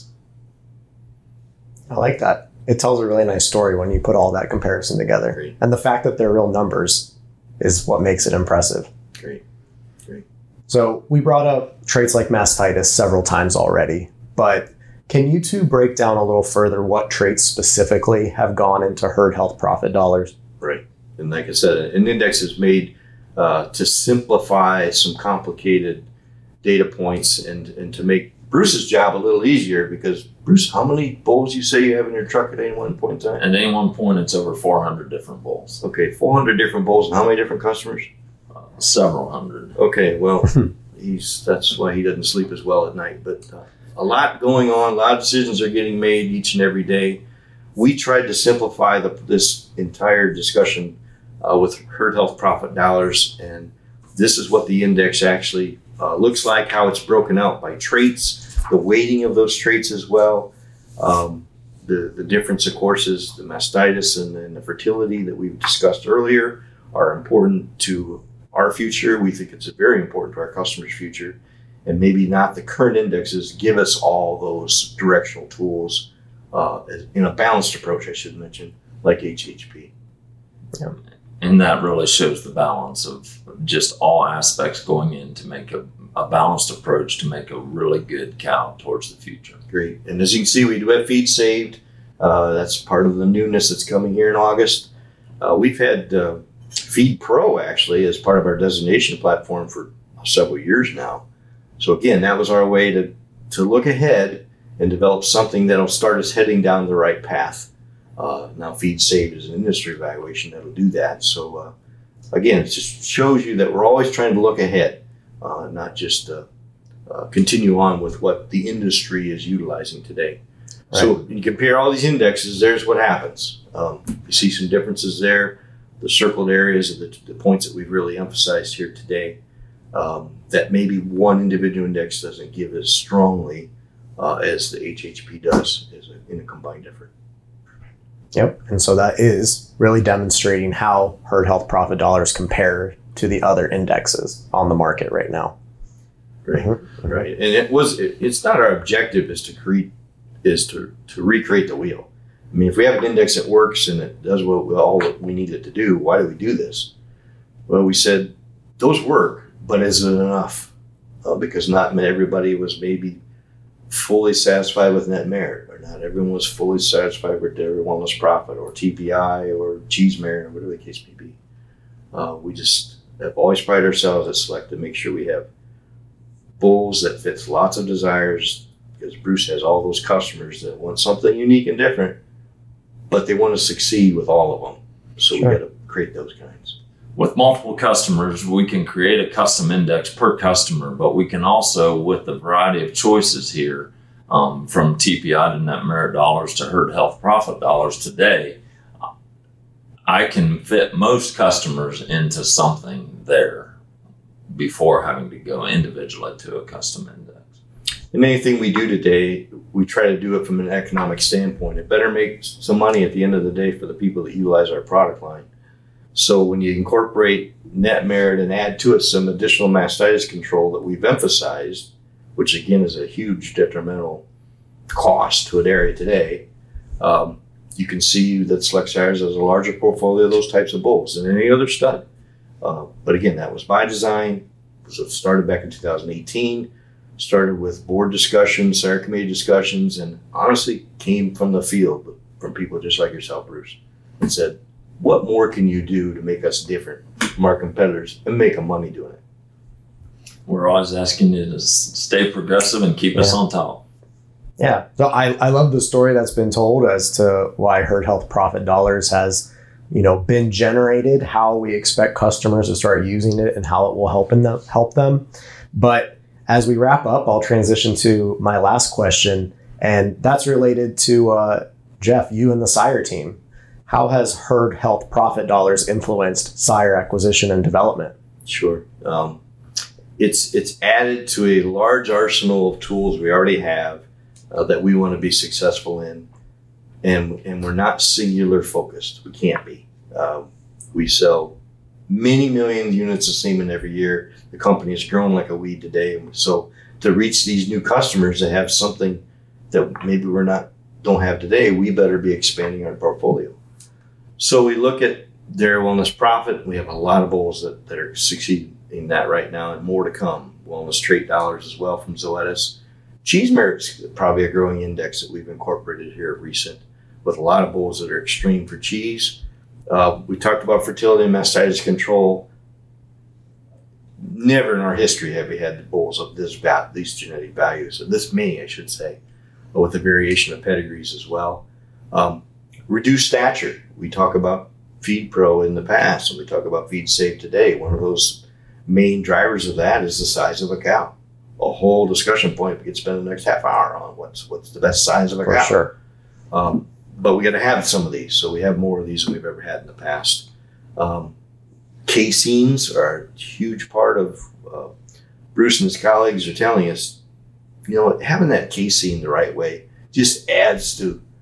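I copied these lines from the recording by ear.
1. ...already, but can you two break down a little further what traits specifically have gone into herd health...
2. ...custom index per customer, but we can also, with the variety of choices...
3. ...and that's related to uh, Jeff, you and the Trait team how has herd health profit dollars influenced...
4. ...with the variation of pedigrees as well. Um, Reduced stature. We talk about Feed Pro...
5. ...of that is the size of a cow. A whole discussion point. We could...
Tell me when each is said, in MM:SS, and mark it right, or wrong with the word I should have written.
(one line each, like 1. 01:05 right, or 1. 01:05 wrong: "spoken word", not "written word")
1. 00:13 right
2. 03:09 right
3. 04:29 wrong: "Sire", not "Trait"
4. 05:29 right
5. 05:39 right.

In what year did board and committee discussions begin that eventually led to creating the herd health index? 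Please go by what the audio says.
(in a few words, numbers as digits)
2018.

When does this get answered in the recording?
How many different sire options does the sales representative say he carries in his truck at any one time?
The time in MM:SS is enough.
00:34.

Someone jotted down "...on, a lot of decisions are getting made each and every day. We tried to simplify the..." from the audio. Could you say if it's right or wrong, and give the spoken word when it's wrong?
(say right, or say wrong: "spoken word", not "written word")
right.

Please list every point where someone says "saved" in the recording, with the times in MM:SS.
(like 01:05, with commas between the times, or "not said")
01:31, 01:48, 05:37.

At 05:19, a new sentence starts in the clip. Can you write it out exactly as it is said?
Uh, we talked about fertility and mastitis control.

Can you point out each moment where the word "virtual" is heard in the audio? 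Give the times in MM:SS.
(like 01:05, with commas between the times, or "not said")
not said.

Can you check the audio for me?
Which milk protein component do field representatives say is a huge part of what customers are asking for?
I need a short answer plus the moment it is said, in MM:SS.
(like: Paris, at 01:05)
caseins, at 05:52.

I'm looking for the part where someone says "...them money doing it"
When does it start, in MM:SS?
04:08.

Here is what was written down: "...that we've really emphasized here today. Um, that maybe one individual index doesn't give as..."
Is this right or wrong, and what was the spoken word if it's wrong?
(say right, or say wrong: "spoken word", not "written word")
right.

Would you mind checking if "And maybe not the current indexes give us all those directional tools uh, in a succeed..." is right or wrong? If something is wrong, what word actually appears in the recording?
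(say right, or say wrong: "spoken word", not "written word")
wrong: "balanced", not "succeed".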